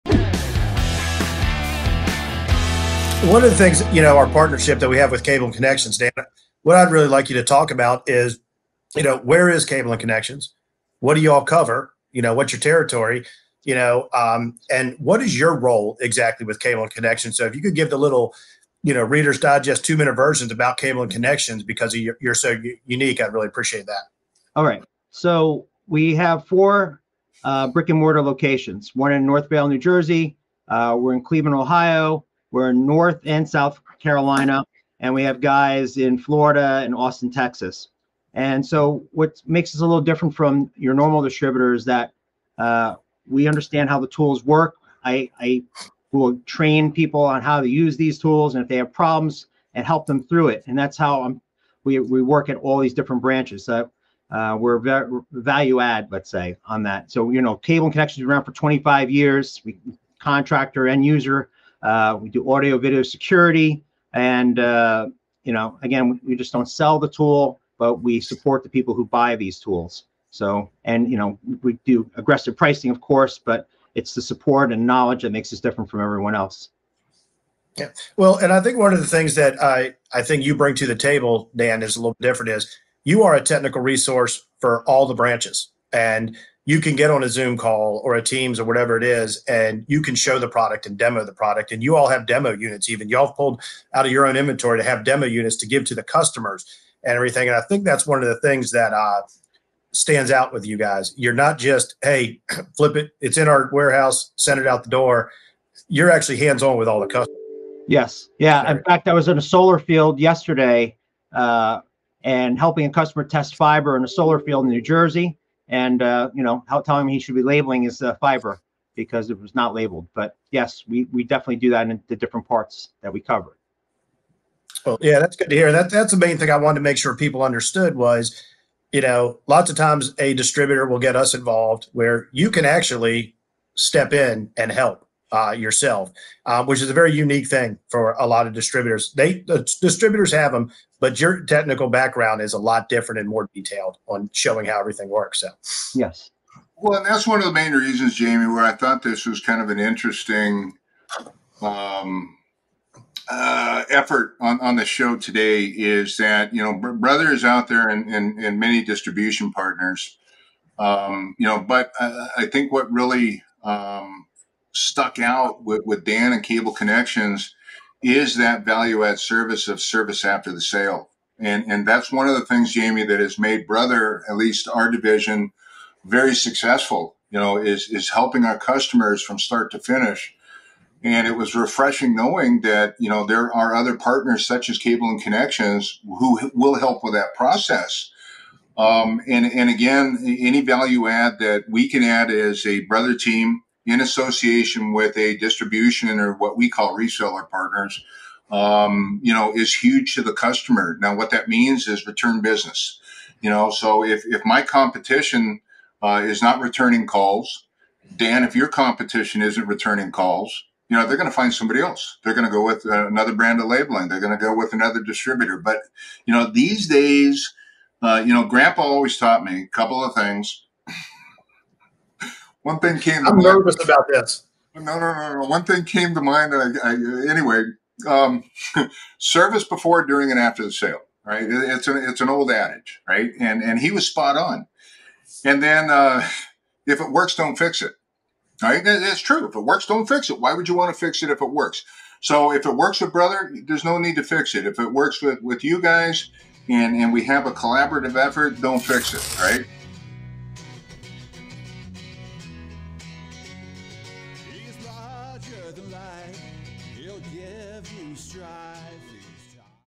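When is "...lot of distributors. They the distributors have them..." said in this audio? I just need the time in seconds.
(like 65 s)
138 s.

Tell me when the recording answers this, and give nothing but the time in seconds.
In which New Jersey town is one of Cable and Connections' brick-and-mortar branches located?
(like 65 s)
29 s.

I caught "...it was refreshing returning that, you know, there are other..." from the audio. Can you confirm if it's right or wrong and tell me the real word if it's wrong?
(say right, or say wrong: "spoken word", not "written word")
wrong: "knowing", not "returning".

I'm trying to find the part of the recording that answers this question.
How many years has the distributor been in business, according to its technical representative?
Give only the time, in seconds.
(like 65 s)
58 s.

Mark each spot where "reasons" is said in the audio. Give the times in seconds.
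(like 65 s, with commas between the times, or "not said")
147 s.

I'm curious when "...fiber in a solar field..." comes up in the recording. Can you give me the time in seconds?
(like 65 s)
113 s.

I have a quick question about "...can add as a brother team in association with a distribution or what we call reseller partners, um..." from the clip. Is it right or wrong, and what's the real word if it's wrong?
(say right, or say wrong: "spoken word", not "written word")
right.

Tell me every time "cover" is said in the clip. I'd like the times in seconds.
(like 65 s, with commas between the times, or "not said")
11 s, 123 s.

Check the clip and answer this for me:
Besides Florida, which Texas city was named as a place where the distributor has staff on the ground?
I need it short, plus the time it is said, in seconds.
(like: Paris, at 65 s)
Austin, at 36 s.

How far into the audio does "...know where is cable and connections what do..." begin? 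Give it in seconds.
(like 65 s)
9 s.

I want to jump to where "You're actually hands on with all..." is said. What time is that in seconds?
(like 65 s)
105 s.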